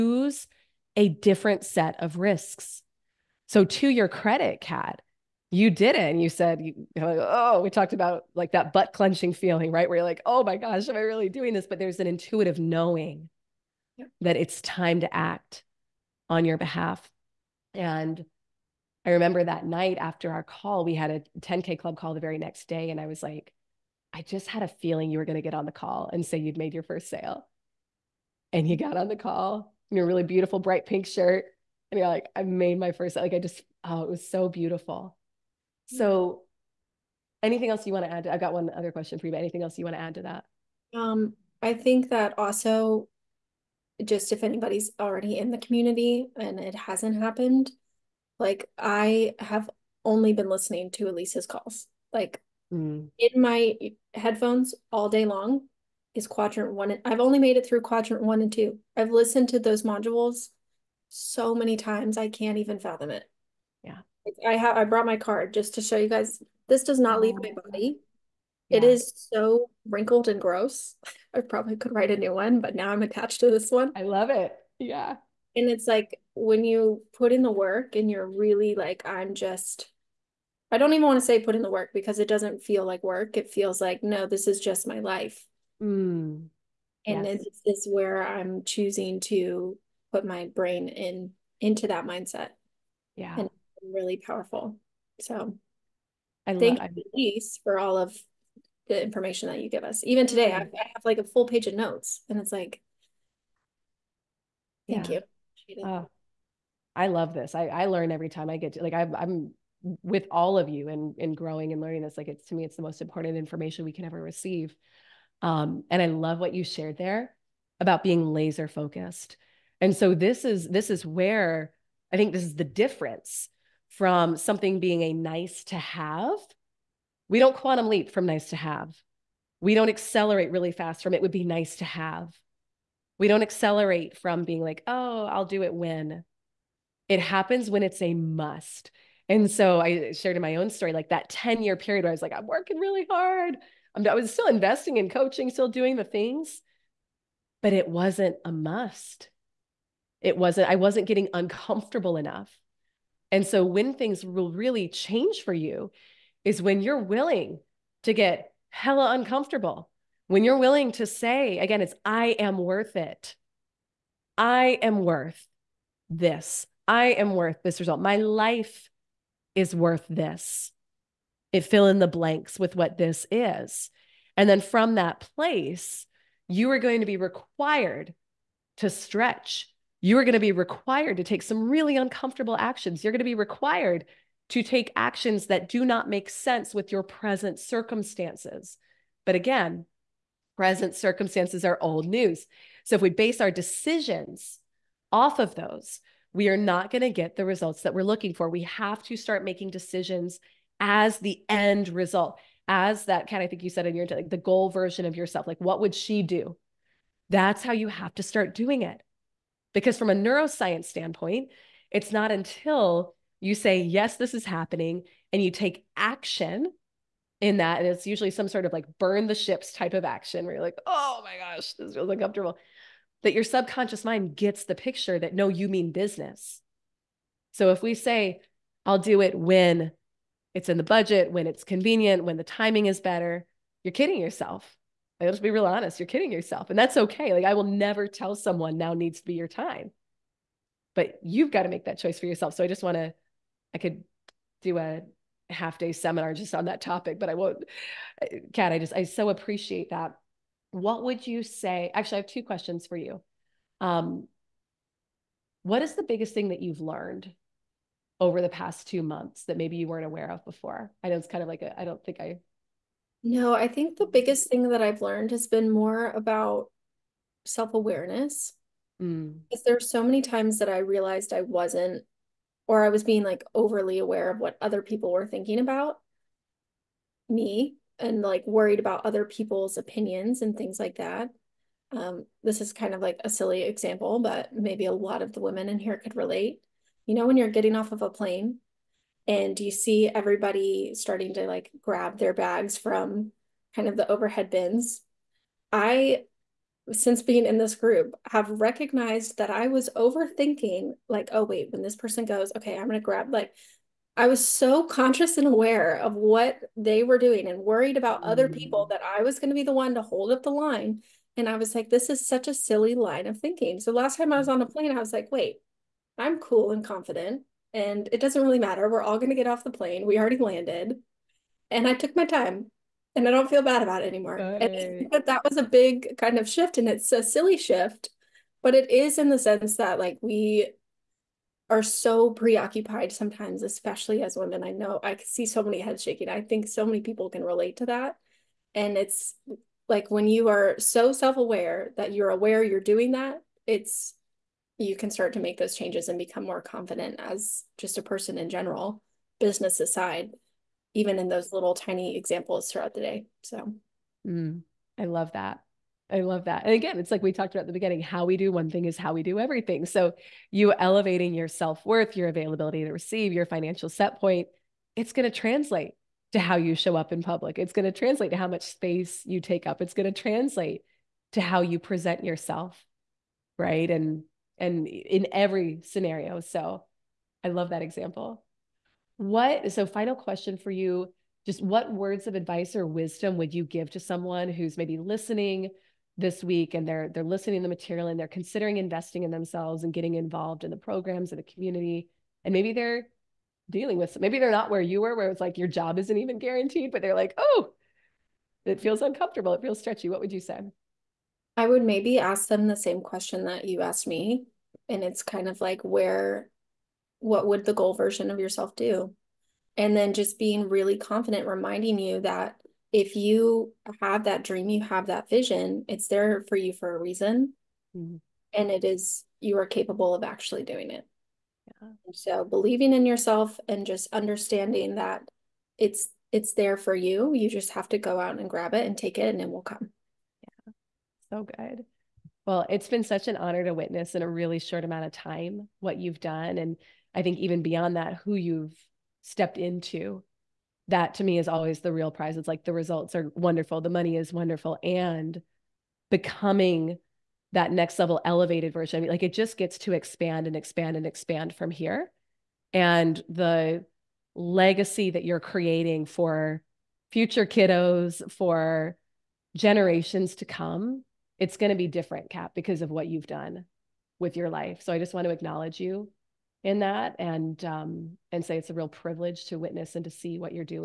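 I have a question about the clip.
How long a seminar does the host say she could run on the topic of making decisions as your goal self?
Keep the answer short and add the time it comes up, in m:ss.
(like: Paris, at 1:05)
half day, at 4:05.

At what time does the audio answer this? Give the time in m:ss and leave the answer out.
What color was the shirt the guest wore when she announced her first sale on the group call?
0:30.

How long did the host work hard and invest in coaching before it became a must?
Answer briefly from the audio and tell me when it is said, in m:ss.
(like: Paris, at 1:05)
10 year period, at 2:21.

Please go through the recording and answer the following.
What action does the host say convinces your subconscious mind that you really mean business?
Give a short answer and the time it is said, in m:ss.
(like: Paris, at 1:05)
burn the ships, at 3:38.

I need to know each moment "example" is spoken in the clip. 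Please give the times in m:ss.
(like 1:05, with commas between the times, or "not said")
4:43, 5:52, 6:17.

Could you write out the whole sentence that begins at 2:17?
It happens when it's a must.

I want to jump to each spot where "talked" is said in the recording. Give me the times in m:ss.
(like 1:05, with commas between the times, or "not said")
0:07, 5:57.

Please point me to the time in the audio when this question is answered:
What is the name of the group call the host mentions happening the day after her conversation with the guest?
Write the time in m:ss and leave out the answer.
0:21.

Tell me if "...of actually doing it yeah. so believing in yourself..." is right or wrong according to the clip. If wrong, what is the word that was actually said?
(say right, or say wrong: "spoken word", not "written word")
right.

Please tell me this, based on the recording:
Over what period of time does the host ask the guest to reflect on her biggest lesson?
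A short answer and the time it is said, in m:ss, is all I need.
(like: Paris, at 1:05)
two months, at 4:18.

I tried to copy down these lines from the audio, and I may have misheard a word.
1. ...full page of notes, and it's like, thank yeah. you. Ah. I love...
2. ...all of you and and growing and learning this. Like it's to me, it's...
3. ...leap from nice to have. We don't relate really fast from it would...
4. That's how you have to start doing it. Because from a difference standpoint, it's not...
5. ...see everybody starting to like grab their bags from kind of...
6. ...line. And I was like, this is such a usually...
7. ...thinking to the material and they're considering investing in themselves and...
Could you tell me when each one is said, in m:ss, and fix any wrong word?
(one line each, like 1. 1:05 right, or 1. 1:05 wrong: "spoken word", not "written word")
1. 1:41 right
2. 1:50 right
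3. 2:07 wrong: "accelerate", not "relate"
4. 3:27 wrong: "neuroscience", not "difference"
5. 4:49 right
6. 5:10 wrong: "silly", not "usually"
7. 6:27 wrong: "listening", not "thinking".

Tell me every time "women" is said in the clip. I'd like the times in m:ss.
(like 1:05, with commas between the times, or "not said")
4:45, 5:34.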